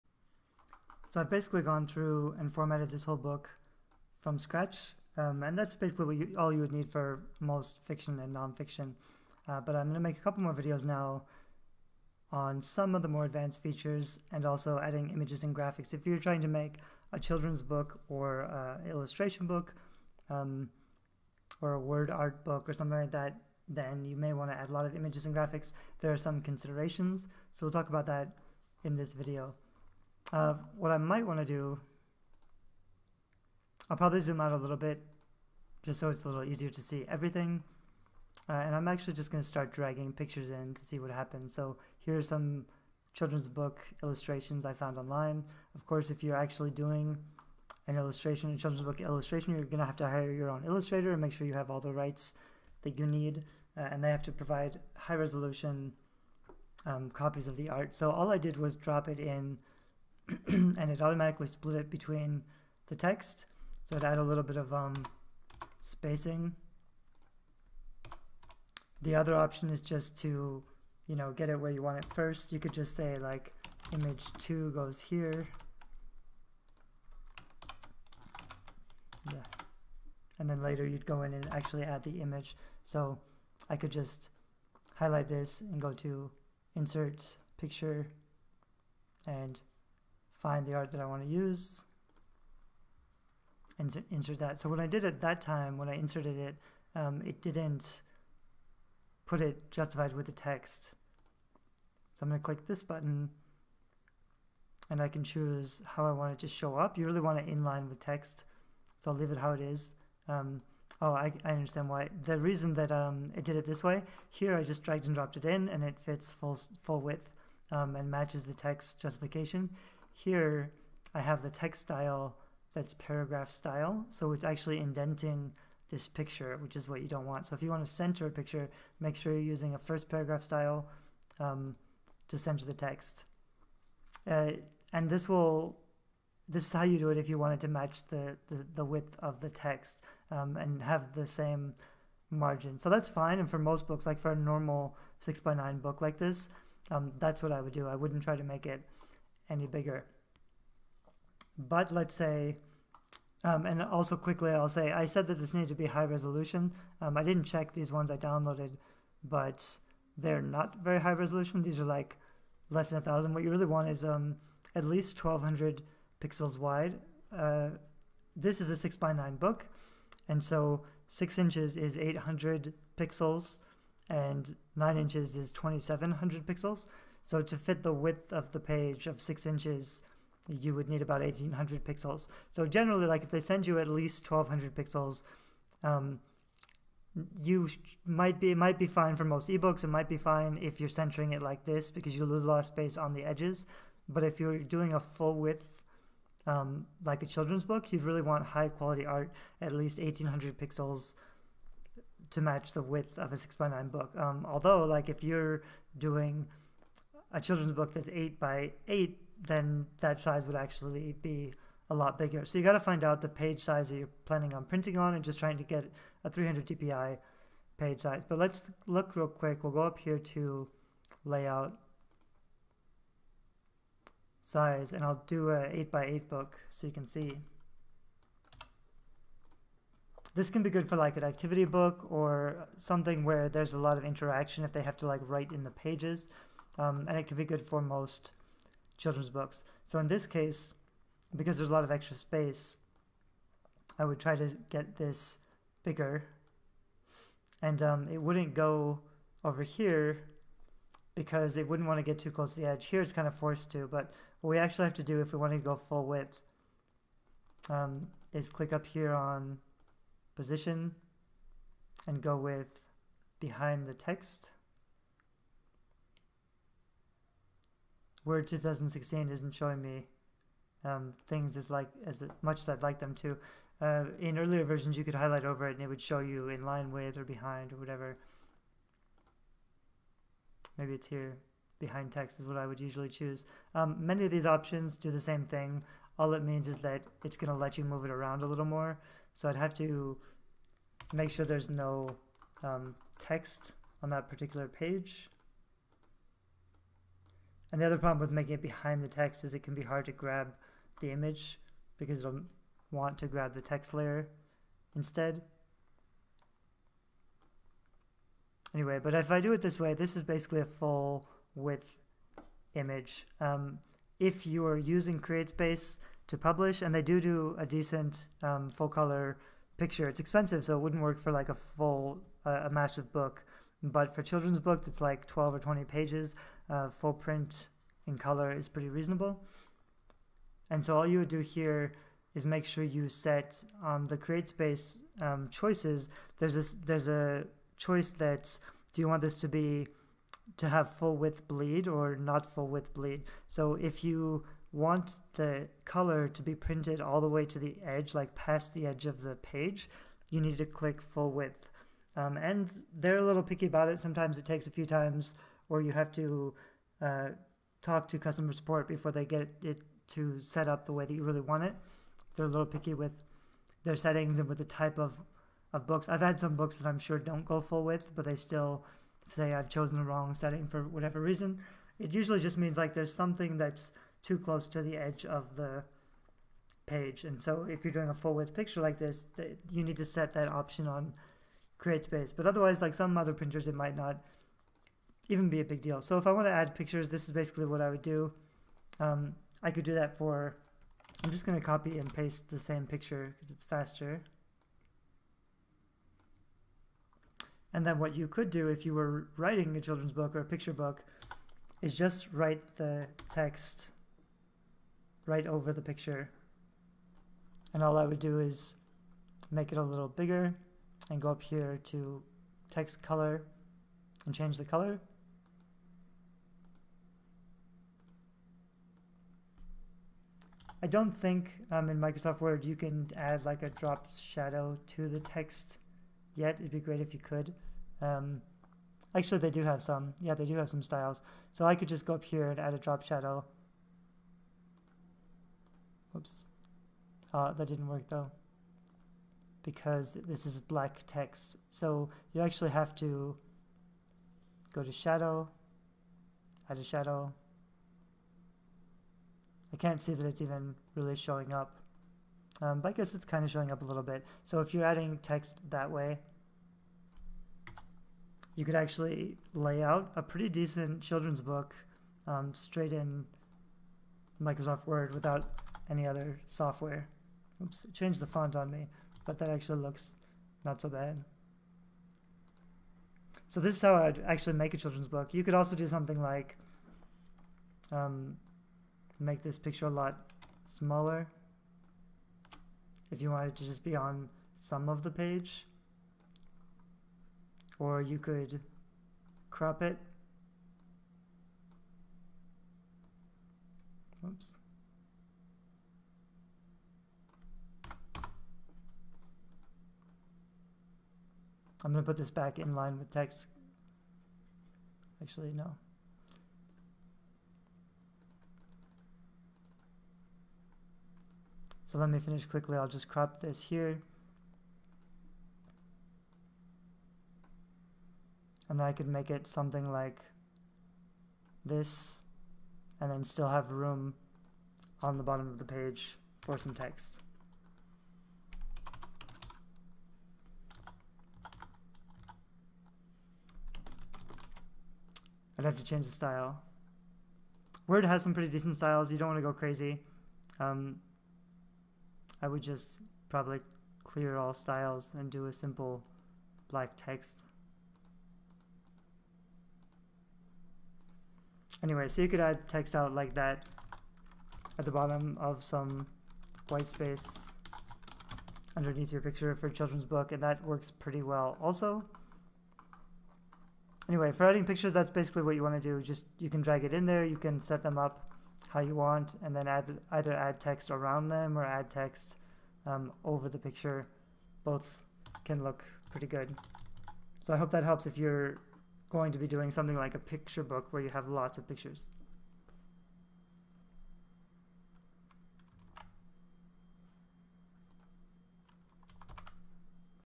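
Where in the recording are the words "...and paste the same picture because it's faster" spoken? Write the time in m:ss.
6:31.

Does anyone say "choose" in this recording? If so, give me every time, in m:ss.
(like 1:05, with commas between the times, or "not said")
1:45, 4:43.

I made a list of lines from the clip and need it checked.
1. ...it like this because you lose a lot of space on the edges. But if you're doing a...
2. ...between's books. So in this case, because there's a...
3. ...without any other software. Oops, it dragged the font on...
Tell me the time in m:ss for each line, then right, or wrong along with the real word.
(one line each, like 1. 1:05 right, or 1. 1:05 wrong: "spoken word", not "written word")
1. 3:11 right
2. 3:59 wrong: "children", not "between"
3. 7:45 wrong: "changed", not "dragged".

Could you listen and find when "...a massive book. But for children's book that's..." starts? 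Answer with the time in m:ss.
5:22.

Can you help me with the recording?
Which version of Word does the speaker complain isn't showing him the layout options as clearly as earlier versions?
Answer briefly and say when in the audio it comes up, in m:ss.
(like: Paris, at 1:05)
Word 2016, at 4:28.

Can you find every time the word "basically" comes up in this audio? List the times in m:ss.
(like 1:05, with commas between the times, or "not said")
0:01, 0:05, 5:10, 6:27, 9:25.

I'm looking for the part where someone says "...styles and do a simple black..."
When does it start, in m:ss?
9:04.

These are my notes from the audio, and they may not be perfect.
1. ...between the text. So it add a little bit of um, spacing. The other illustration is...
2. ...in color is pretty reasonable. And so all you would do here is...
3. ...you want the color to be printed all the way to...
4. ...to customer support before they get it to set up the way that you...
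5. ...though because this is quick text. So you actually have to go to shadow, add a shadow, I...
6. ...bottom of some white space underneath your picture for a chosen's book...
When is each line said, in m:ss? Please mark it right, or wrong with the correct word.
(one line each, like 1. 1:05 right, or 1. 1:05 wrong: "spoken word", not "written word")
1. 1:01 wrong: "option", not "illustration"
2. 5:28 right
3. 5:44 right
4. 5:58 right
5. 7:18 wrong: "black", not "quick"
6. 9:14 wrong: "children", not "chosen".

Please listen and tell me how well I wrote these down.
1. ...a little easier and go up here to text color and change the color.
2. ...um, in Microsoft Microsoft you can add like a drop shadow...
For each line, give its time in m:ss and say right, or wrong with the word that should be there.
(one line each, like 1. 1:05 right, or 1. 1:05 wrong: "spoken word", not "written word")
1. 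6:49 wrong: "bigger", not "easier"
2. 7:01 wrong: "Word", not "Microsoft".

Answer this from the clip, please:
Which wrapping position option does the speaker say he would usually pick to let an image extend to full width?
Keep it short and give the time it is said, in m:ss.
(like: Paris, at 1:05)
Behind text, at 4:41.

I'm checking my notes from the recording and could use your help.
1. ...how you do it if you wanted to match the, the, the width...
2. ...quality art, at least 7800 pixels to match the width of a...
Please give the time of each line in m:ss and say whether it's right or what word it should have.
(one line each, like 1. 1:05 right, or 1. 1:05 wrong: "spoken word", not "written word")
1. 2:16 right
2. 3:18 wrong: "1800", not "7800".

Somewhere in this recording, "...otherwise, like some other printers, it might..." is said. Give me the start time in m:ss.
6:22.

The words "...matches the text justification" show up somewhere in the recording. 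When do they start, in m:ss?
1:58.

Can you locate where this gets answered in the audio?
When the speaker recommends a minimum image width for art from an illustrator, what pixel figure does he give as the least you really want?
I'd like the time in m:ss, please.
2:45.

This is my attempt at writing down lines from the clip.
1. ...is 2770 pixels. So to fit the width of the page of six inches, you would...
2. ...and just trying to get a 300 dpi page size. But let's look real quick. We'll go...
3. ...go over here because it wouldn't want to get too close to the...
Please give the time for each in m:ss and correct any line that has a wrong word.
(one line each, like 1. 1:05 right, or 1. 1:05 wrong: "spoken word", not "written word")
1. 2:55 wrong: "2700", not "2770"
2. 3:35 right
3. 4:08 right.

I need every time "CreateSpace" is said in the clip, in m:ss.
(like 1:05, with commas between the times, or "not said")
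5:15, 5:34, 6:21.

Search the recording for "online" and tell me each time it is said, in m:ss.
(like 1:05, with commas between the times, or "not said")
0:44.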